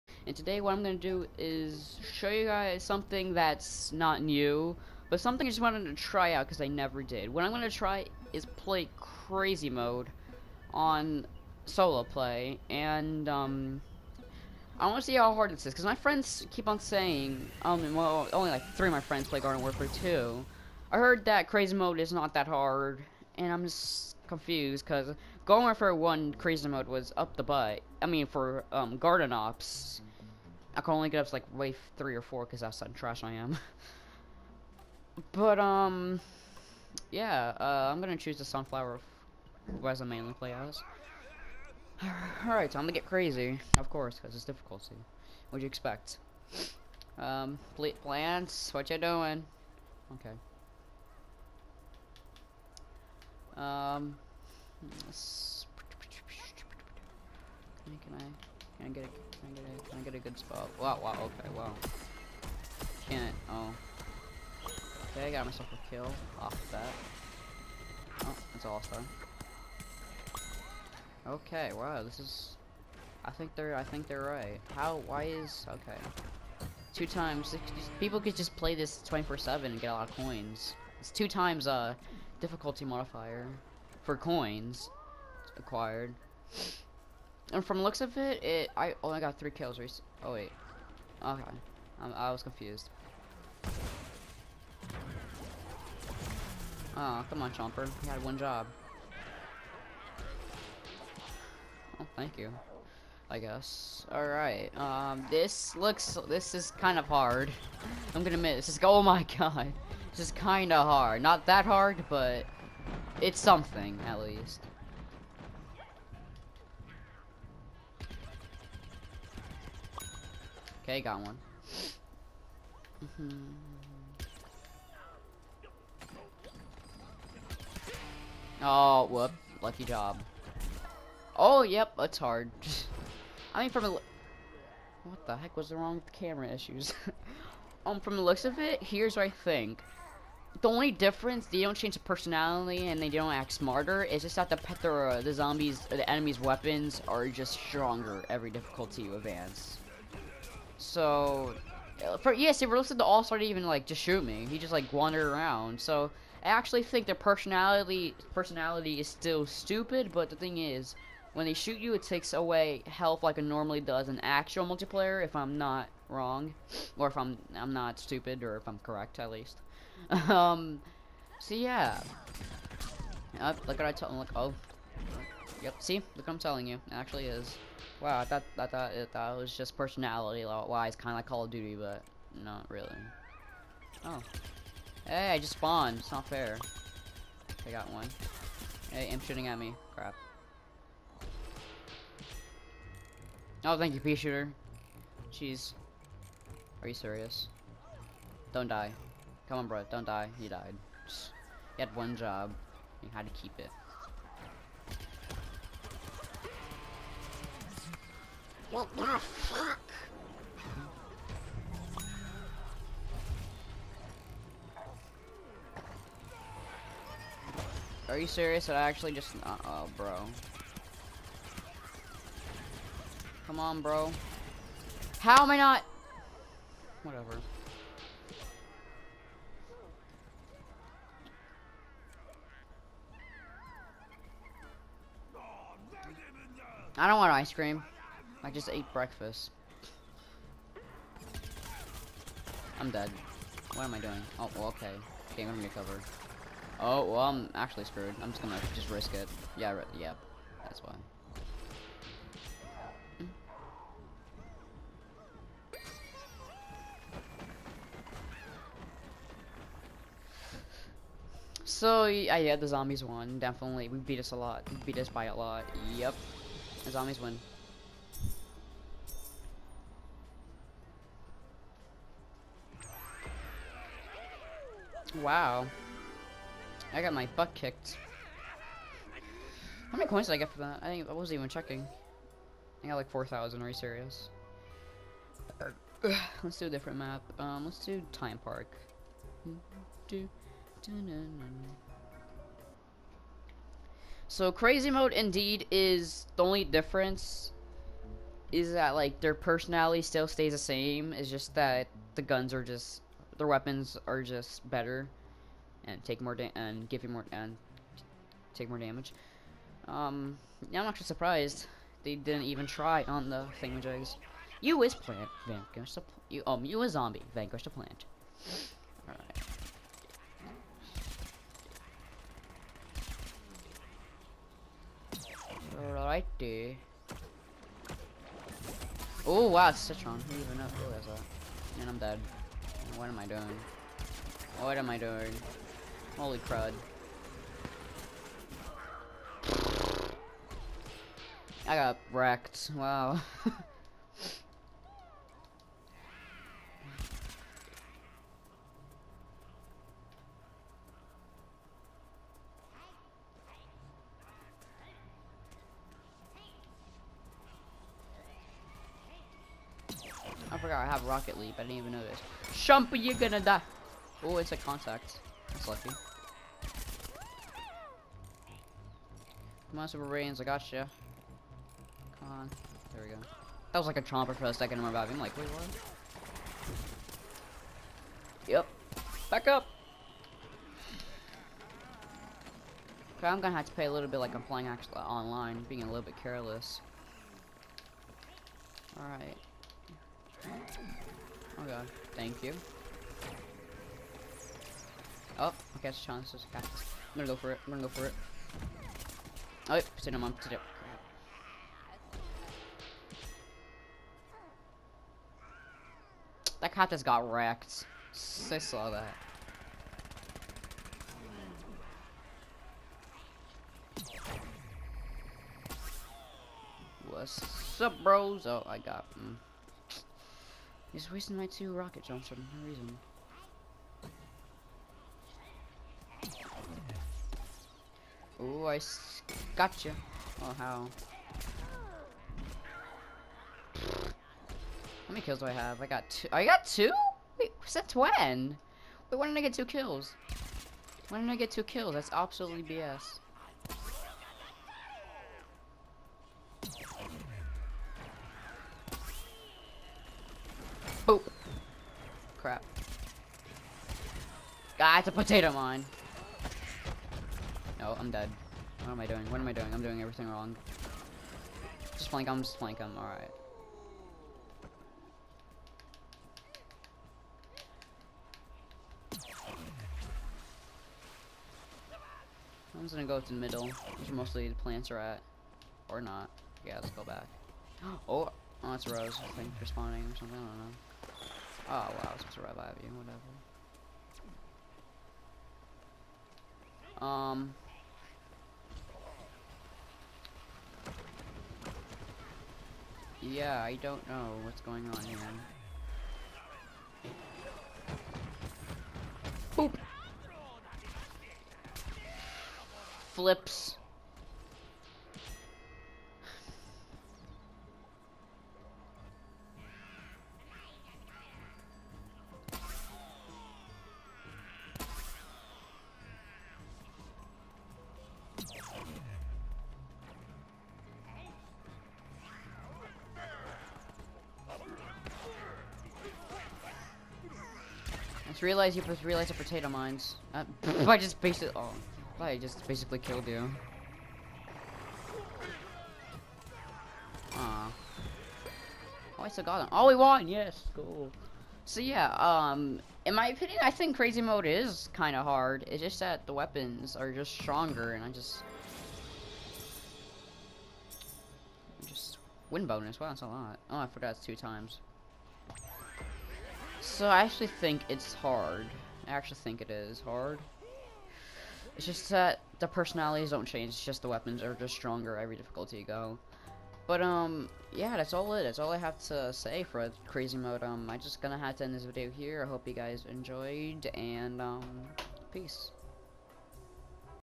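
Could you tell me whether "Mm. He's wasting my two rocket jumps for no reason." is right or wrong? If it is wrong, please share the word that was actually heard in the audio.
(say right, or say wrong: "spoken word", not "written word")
right.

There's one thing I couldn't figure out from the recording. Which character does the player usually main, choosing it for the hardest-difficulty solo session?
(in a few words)
Sunflower.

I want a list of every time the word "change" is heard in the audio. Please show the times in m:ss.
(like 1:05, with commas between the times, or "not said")
2:21, 9:23.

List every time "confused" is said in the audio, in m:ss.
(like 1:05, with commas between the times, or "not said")
0:24, 1:32.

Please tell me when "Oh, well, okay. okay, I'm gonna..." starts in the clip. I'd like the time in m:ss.
4:04.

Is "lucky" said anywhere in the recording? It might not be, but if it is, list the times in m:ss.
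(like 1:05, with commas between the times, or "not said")
2:09, 6:05.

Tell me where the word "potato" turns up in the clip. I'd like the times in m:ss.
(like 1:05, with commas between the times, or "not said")
7:35, 8:49.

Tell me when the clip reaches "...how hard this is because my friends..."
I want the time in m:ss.
0:15.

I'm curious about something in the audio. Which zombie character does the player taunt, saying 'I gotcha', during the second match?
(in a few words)
Super Brainz.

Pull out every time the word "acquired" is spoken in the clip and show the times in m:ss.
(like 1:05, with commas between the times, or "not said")
1:25.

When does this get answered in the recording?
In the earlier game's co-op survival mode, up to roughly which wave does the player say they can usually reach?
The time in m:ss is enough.
0:31.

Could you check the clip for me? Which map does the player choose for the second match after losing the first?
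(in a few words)
Time Park.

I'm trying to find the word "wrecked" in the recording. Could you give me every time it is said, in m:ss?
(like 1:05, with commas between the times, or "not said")
5:42, 6:47.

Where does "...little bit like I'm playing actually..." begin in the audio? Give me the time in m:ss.
6:23.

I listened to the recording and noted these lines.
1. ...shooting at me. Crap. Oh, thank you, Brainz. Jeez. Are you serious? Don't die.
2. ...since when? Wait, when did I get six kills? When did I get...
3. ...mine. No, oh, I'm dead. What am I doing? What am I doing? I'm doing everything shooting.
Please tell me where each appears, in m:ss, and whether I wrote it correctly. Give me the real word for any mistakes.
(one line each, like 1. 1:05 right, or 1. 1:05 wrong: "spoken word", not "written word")
1. 3:09 wrong: "Peashooter", not "Brainz"
2. 7:17 wrong: "two", not "six"
3. 7:35 wrong: "wrong", not "shooting".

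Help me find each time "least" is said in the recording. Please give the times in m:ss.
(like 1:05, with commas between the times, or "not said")
1:54, 2:49.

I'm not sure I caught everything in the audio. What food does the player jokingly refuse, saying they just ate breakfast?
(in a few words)
ice cream.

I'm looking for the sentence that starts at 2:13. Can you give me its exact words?
What the heck was wrong with the camera issues?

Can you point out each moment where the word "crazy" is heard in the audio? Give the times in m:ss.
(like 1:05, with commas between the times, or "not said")
0:08, 0:21, 0:26, 0:43, 4:54, 9:03, 9:30.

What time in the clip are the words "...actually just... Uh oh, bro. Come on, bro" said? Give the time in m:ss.
3:38.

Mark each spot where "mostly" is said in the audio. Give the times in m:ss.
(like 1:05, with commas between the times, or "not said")
7:54.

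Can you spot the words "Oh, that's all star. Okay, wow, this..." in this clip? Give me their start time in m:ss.
1:08.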